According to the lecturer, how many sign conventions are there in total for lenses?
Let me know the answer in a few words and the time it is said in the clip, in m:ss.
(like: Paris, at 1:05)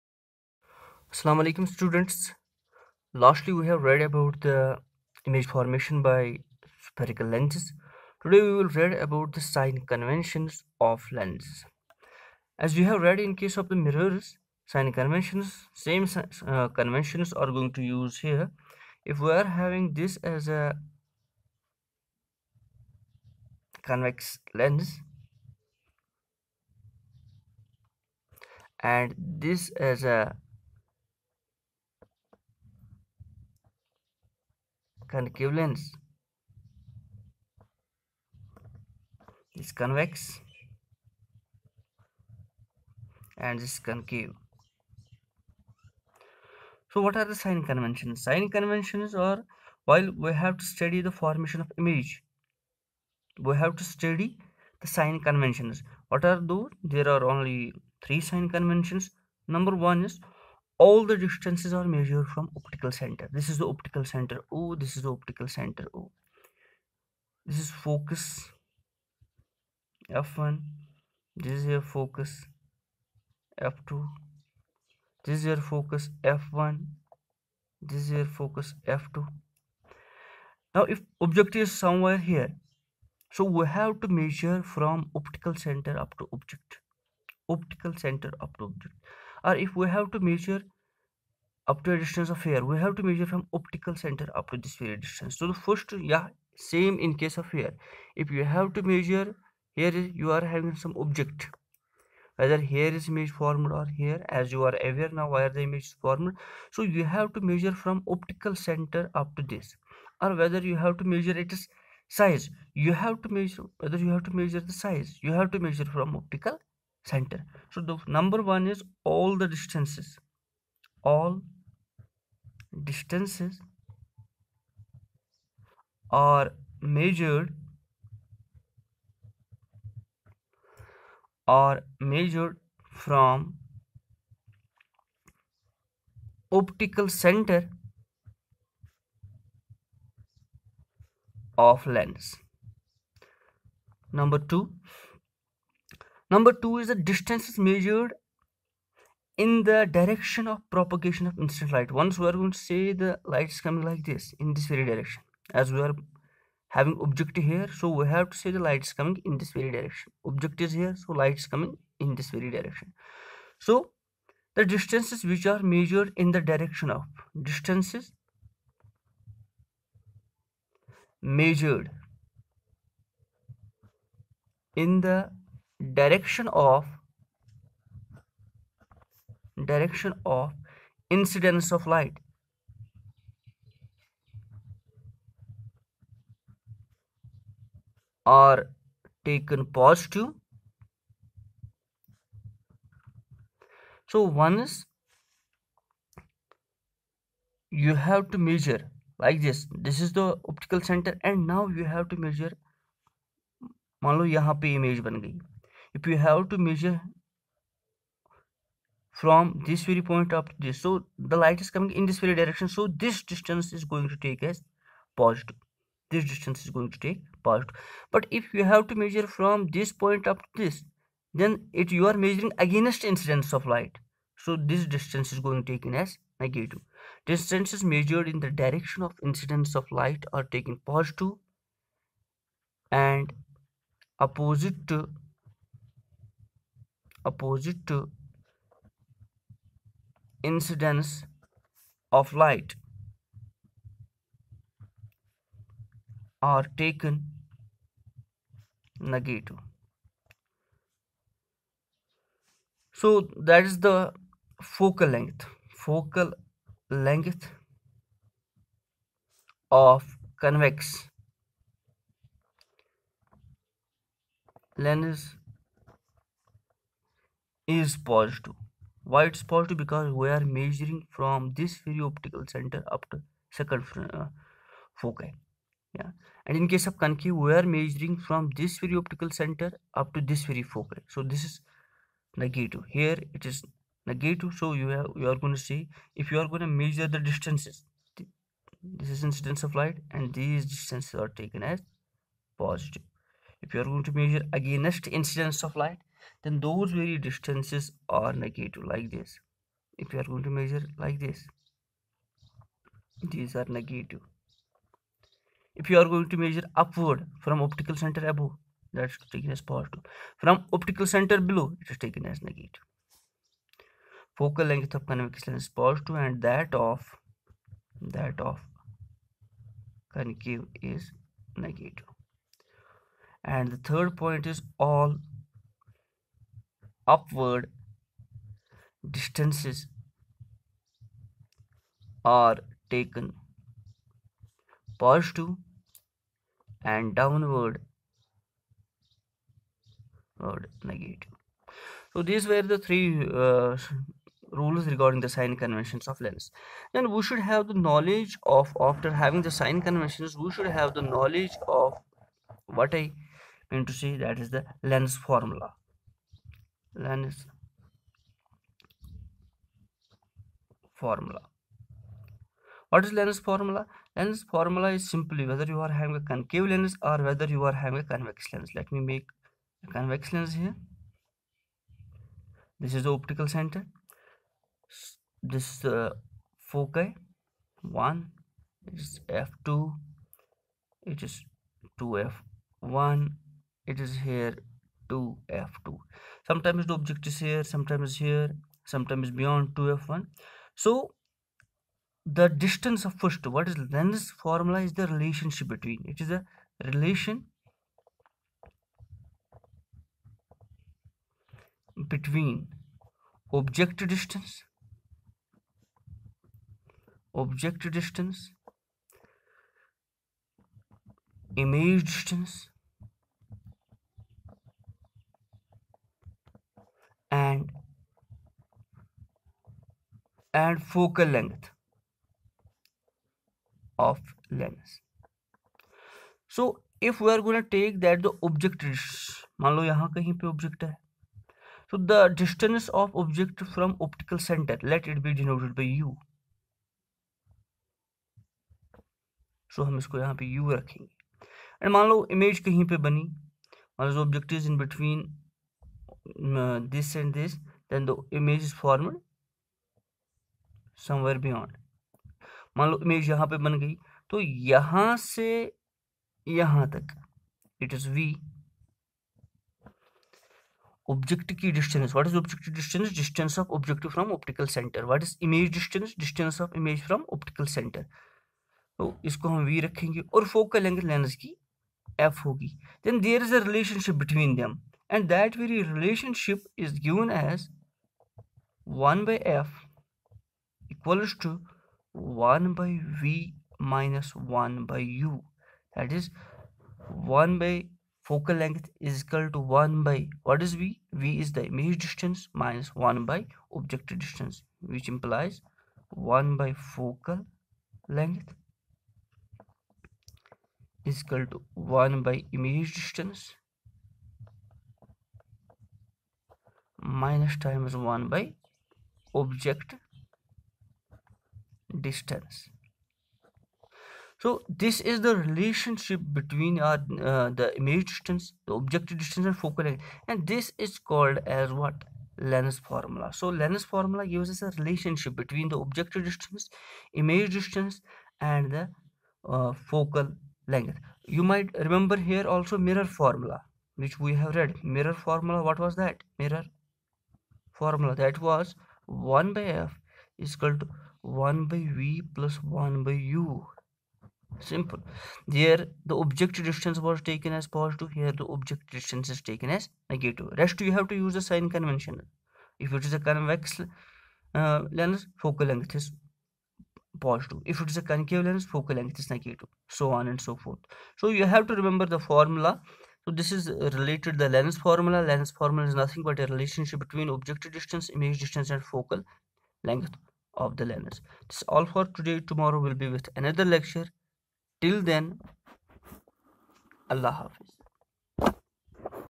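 3, at 0:56.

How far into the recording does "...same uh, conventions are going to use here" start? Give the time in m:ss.
0:15.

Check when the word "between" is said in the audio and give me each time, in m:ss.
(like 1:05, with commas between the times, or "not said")
6:35, 6:42, 8:36, 8:45, 9:26.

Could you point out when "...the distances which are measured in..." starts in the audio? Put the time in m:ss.
2:44.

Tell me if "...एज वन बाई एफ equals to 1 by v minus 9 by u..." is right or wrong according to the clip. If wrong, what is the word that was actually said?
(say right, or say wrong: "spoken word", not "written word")
wrong: "1", not "9".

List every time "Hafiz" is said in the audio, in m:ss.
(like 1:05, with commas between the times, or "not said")
9:37.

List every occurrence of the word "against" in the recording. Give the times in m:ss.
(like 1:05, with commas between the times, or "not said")
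3:42, 4:54.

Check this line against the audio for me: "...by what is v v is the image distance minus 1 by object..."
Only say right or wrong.
right.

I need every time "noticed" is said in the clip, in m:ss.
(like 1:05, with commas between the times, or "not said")
not said.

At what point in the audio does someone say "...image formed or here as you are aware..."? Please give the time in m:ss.
1:43.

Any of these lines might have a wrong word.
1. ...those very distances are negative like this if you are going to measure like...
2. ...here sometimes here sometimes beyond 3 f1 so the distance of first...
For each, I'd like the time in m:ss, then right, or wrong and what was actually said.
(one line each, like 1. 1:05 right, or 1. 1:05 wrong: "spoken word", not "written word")
1. 4:56 right
2. 6:27 wrong: "2", not "3".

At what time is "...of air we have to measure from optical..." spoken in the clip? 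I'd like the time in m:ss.
1:32.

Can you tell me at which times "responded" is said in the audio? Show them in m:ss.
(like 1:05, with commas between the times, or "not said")
not said.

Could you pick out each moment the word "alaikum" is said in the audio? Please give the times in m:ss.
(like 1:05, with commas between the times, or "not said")
0:01.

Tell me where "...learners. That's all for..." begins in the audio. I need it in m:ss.
9:30.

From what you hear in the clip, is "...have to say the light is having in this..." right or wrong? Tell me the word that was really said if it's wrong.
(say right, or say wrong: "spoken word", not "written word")
wrong: "coming", not "having".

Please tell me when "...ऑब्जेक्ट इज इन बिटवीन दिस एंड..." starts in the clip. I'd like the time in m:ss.
7:24.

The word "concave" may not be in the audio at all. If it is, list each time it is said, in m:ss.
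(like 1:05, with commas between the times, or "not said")
0:35, 0:43, 4:36, 5:20, 6:06, 9:18.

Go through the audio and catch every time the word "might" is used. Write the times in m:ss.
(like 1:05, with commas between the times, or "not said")
8:51.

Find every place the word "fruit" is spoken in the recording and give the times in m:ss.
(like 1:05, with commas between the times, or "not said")
not said.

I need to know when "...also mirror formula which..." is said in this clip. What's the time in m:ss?
8:52.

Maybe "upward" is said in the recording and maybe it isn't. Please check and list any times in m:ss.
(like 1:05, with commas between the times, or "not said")
5:06, 5:27.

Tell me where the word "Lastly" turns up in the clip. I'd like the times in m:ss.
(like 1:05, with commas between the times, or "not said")
0:03.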